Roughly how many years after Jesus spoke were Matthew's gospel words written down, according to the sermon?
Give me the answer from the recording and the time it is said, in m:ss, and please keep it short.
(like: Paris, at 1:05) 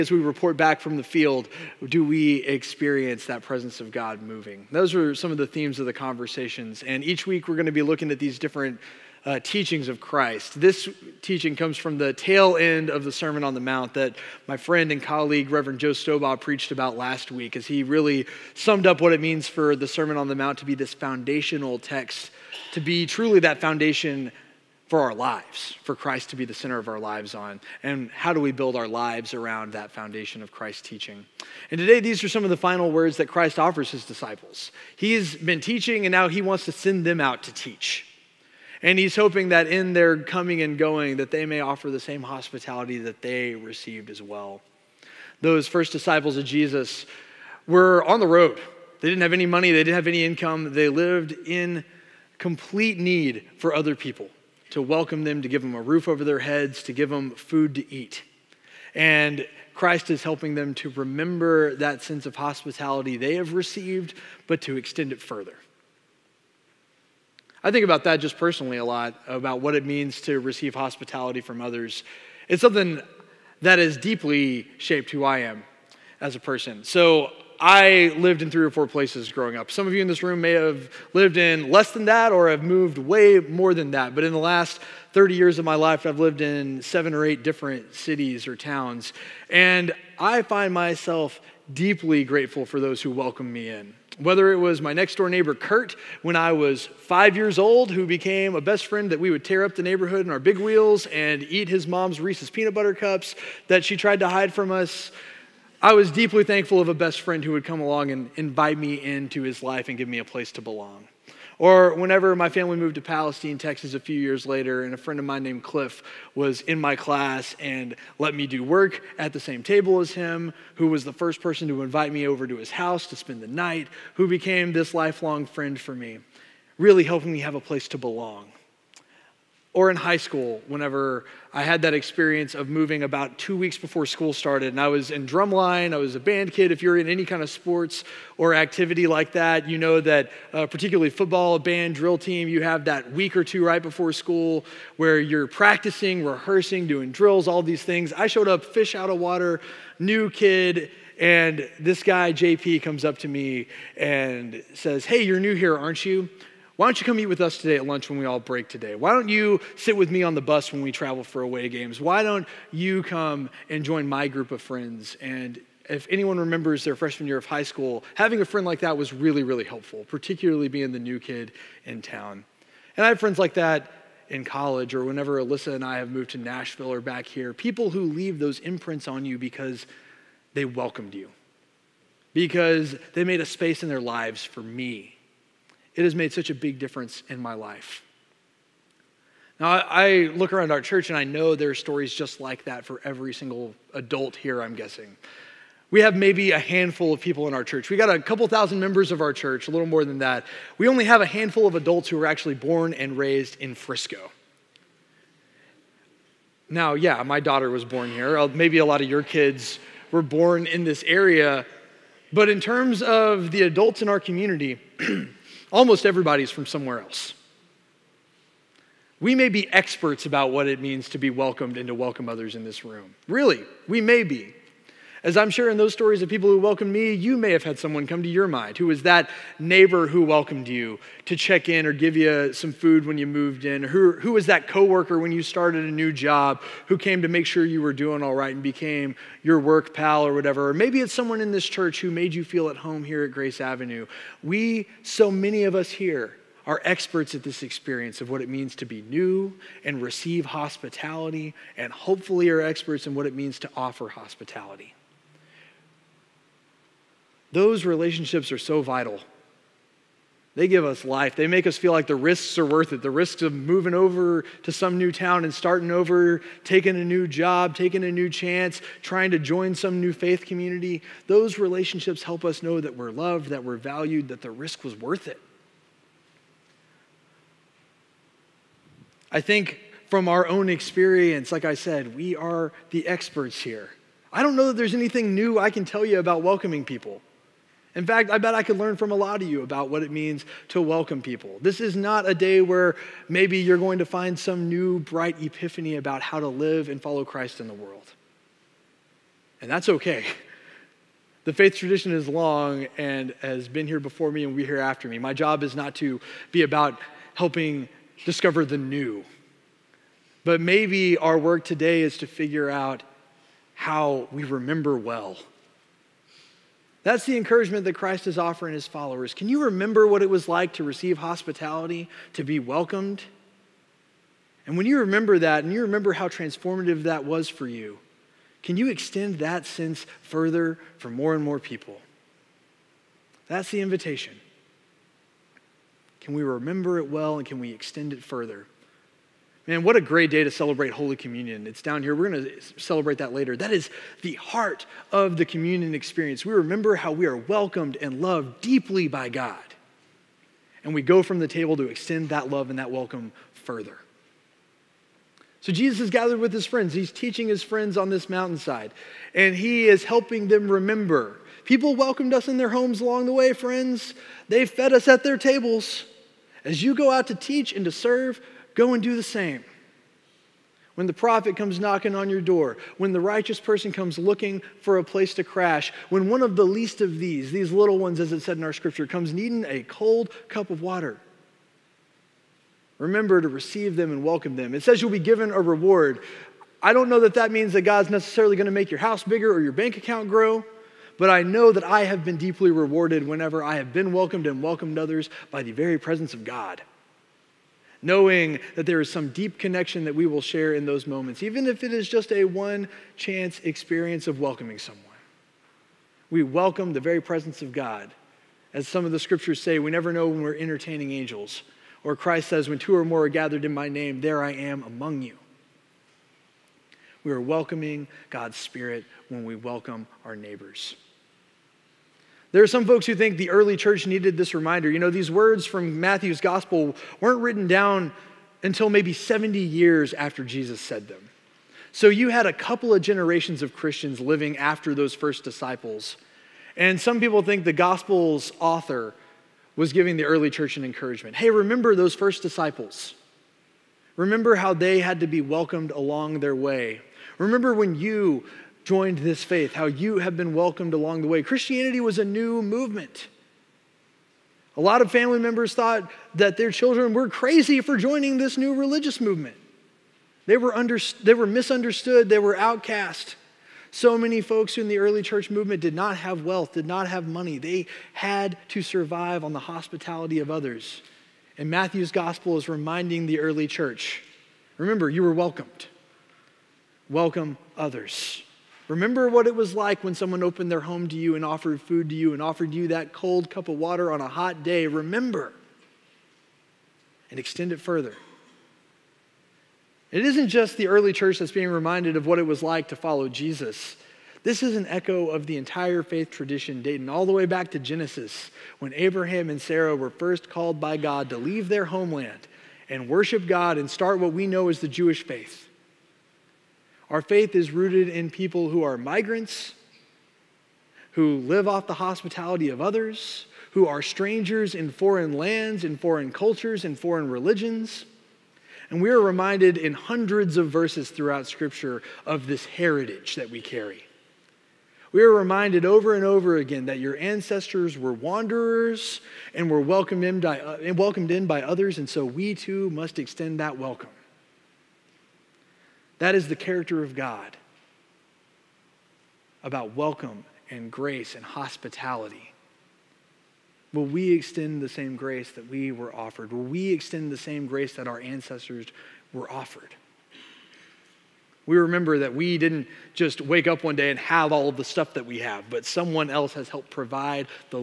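70, at 7:09.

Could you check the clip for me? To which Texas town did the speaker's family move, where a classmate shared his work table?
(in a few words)
Palestine, Texas.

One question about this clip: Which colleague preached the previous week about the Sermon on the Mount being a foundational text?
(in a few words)
Joe Stobaugh.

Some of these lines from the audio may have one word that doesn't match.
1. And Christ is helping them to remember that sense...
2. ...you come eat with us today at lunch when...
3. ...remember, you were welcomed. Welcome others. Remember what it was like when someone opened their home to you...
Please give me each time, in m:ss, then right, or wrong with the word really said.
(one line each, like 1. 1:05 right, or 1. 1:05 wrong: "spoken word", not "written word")
1. 0:58 right
2. 2:37 right
3. 7:54 right.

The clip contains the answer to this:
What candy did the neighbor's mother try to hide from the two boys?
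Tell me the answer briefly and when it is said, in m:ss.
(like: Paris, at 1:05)
Reese's peanut butter cups, at 1:42.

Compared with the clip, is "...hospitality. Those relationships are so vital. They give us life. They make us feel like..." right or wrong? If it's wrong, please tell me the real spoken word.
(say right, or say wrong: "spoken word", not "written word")
right.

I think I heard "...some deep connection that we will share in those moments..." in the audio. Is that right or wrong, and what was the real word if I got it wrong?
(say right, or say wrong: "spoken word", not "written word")
right.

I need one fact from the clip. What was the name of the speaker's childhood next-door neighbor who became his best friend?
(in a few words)
Kurt.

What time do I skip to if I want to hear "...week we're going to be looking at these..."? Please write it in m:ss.
0:07.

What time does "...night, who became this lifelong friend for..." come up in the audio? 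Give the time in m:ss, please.
2:03.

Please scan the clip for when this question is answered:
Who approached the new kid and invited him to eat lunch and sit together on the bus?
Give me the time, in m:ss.
2:32.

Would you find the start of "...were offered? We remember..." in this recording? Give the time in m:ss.
9:09.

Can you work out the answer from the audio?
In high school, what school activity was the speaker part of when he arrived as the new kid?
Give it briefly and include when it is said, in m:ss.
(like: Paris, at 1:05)
Drumline, at 2:15.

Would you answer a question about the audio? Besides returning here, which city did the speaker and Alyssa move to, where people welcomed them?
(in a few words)
Nashville.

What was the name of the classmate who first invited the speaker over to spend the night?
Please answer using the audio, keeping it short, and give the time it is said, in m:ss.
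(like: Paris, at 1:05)
Cliff, at 1:55.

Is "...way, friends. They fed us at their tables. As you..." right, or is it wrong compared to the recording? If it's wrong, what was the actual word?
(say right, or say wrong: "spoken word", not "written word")
right.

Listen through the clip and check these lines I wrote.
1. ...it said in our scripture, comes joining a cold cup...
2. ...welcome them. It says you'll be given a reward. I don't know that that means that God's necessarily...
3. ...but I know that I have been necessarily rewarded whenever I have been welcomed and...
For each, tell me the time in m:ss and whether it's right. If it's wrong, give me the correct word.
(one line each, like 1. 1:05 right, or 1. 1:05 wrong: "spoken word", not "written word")
1. 6:18 wrong: "needing", not "joining"
2. 6:24 right
3. 6:31 wrong: "deeply", not "necessarily".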